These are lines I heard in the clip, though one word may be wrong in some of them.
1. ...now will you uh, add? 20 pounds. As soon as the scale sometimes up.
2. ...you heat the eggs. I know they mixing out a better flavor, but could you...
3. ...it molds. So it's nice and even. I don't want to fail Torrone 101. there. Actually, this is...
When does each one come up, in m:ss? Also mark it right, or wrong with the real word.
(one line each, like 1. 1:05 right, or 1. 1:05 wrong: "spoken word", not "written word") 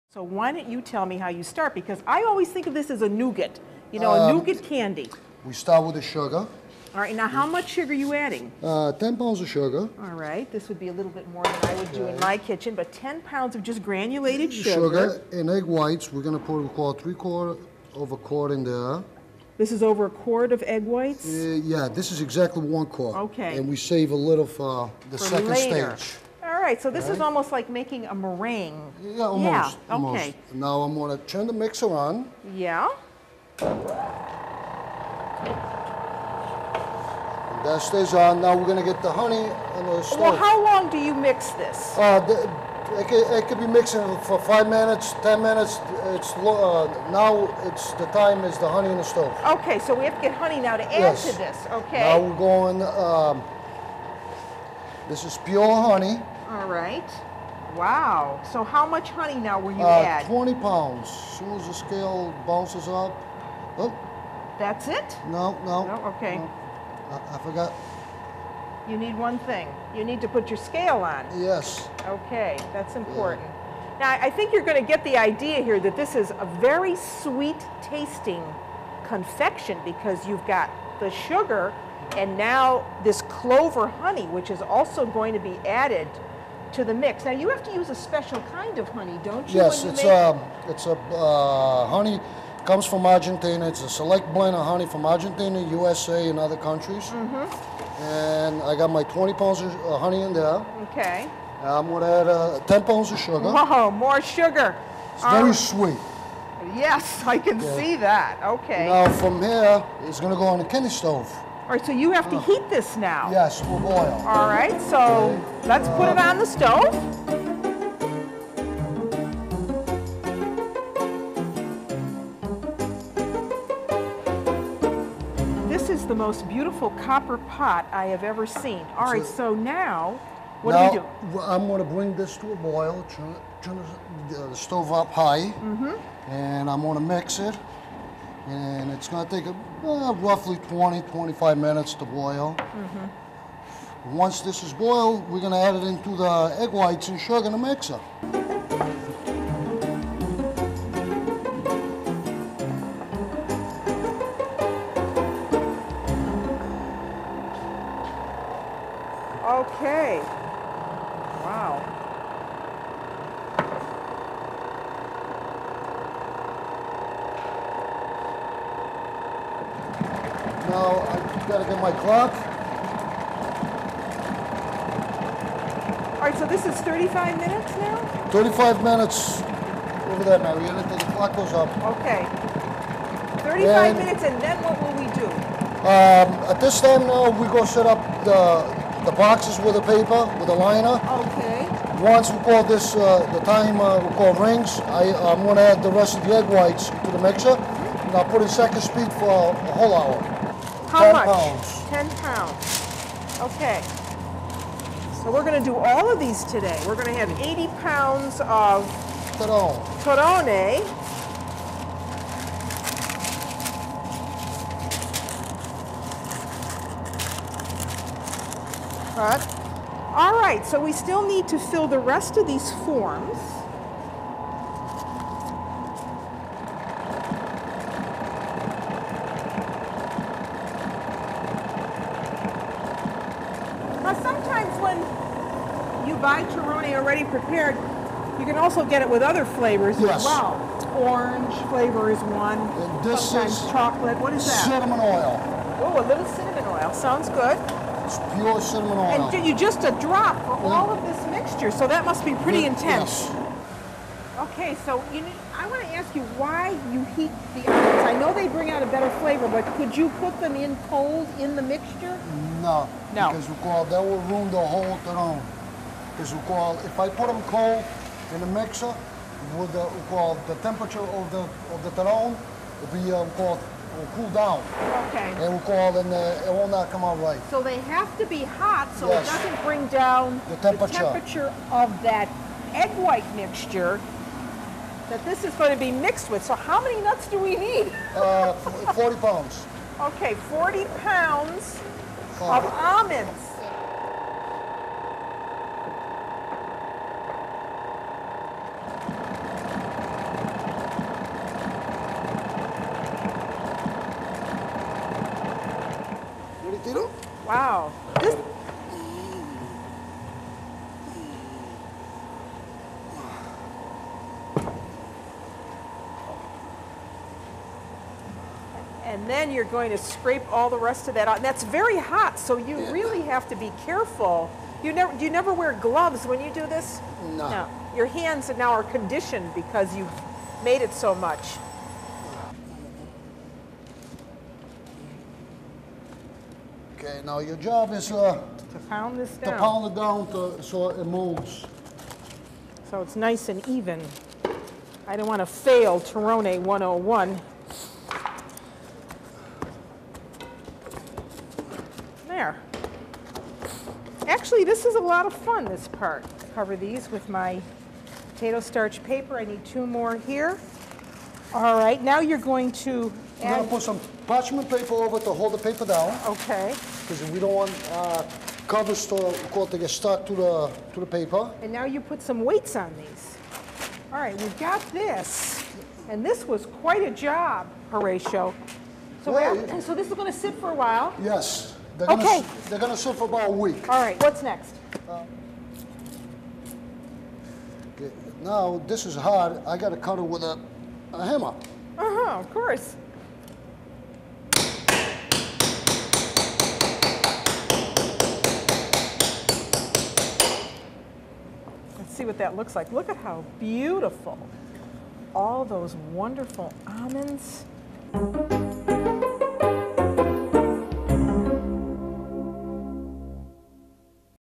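1. 0:59 wrong: "bounces", not "sometimes"
2. 4:16 wrong: "bring", not "mixing"
3. 5:40 right.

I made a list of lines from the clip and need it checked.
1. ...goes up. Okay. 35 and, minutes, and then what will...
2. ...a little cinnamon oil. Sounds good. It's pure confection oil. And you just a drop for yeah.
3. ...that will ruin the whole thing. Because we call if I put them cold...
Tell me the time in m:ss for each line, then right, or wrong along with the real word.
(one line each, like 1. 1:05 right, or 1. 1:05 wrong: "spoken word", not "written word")
1. 3:01 right
2. 4:06 wrong: "cinnamon", not "confection"
3. 4:23 right.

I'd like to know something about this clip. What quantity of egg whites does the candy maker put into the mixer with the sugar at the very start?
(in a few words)
1 quart.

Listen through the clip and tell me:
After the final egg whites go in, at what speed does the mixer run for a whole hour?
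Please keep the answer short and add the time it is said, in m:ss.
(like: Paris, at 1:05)
Second speed, at 3:18.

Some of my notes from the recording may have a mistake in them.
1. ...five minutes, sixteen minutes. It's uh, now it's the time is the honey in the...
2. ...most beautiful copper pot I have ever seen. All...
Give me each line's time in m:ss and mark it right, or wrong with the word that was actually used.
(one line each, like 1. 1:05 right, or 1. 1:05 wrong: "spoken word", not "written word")
1. 0:44 wrong: "ten", not "sixteen"
2. 2:06 right.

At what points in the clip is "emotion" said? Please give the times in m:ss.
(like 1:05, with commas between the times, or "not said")
not said.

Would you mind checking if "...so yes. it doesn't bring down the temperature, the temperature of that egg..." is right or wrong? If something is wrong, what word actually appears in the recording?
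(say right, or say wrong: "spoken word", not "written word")
right.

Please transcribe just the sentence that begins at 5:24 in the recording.
You never, you never wear gloves when you do this?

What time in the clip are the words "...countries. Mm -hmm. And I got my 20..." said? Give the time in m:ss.
1:36.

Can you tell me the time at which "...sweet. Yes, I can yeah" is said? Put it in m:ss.
1:45.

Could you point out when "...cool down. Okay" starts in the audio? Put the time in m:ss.
4:34.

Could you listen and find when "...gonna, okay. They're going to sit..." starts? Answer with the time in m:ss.
6:22.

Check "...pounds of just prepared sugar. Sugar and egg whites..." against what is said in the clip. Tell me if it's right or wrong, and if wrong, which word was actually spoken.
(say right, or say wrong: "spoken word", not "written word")
wrong: "granulated", not "prepared".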